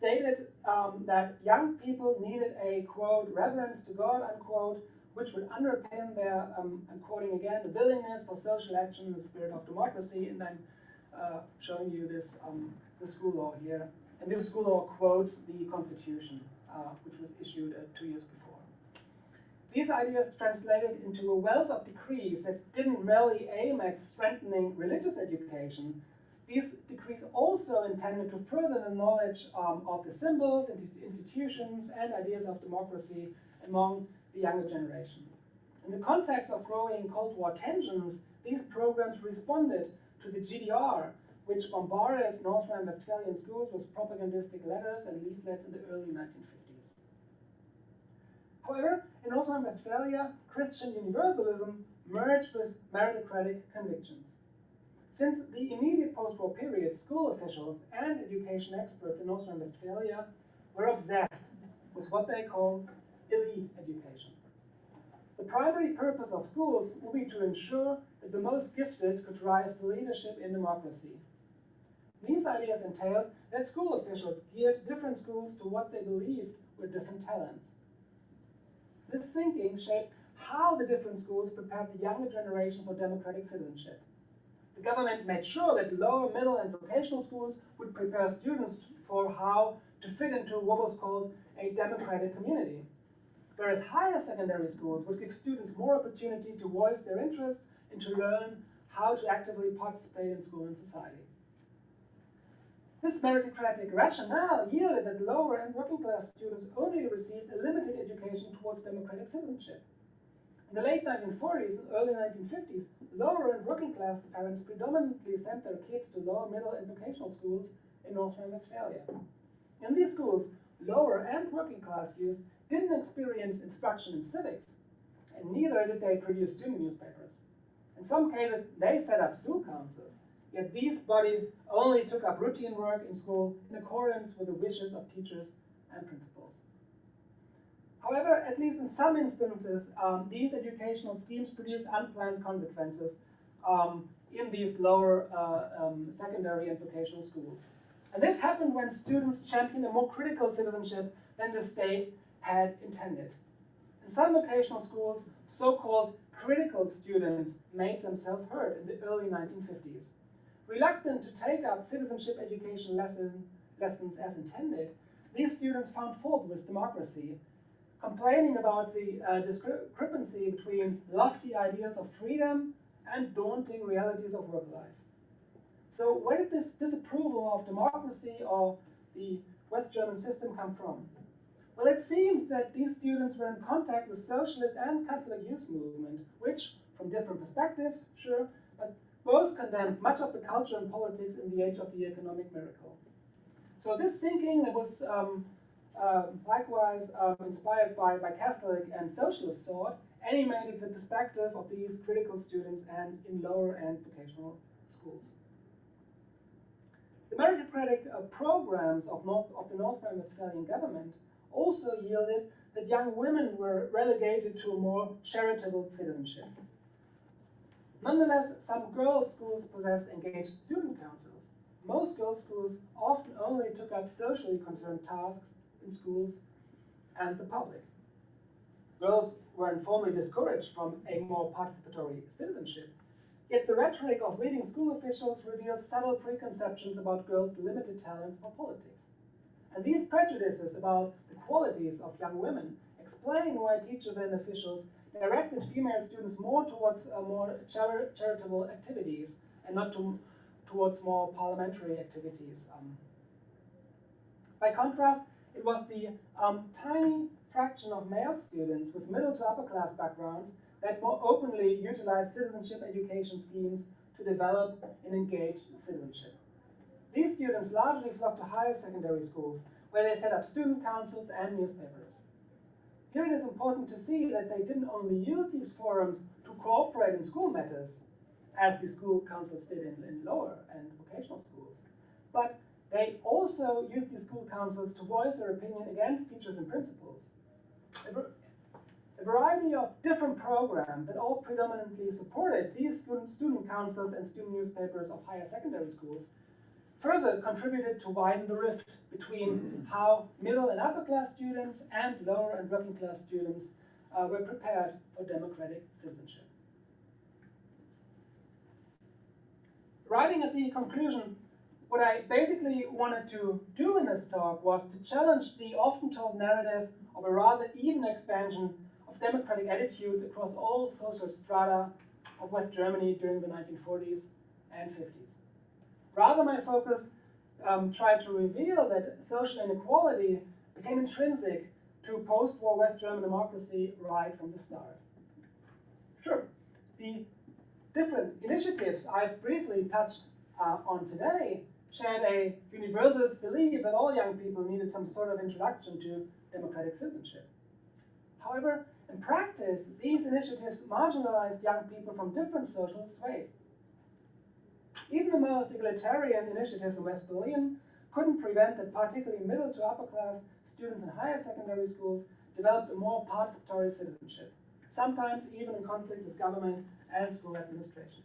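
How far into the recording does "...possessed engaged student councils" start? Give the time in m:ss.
3:39.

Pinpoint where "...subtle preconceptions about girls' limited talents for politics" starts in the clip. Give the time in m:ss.
3:55.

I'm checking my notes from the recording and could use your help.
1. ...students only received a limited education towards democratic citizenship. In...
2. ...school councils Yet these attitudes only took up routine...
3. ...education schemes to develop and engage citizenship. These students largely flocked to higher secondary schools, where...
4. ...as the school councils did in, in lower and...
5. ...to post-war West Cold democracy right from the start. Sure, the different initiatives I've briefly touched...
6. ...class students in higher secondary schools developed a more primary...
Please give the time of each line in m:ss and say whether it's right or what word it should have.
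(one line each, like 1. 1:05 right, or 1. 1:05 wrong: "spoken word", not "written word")
1. 1:46 right
2. 2:09 wrong: "bodies", not "attitudes"
3. 4:22 right
4. 4:38 right
5. 5:32 wrong: "German", not "Cold"
6. 6:00 wrong: "participatory", not "primary".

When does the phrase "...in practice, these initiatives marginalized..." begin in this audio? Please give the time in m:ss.
5:49.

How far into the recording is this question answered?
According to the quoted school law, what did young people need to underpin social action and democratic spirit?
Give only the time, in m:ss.
0:03.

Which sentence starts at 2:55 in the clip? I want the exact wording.
So where did this disapproval of democracy or the West German system come from?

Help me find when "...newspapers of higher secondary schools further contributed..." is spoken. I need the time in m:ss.
4:54.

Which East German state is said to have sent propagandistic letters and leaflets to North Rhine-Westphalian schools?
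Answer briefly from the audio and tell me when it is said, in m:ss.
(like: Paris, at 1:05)
GDR, at 0:40.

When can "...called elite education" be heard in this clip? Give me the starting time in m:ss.
1:02.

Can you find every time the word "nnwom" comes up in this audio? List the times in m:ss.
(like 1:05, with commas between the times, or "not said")
not said.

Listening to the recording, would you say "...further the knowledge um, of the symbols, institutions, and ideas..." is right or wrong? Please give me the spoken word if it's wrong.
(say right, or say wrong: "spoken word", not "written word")
right.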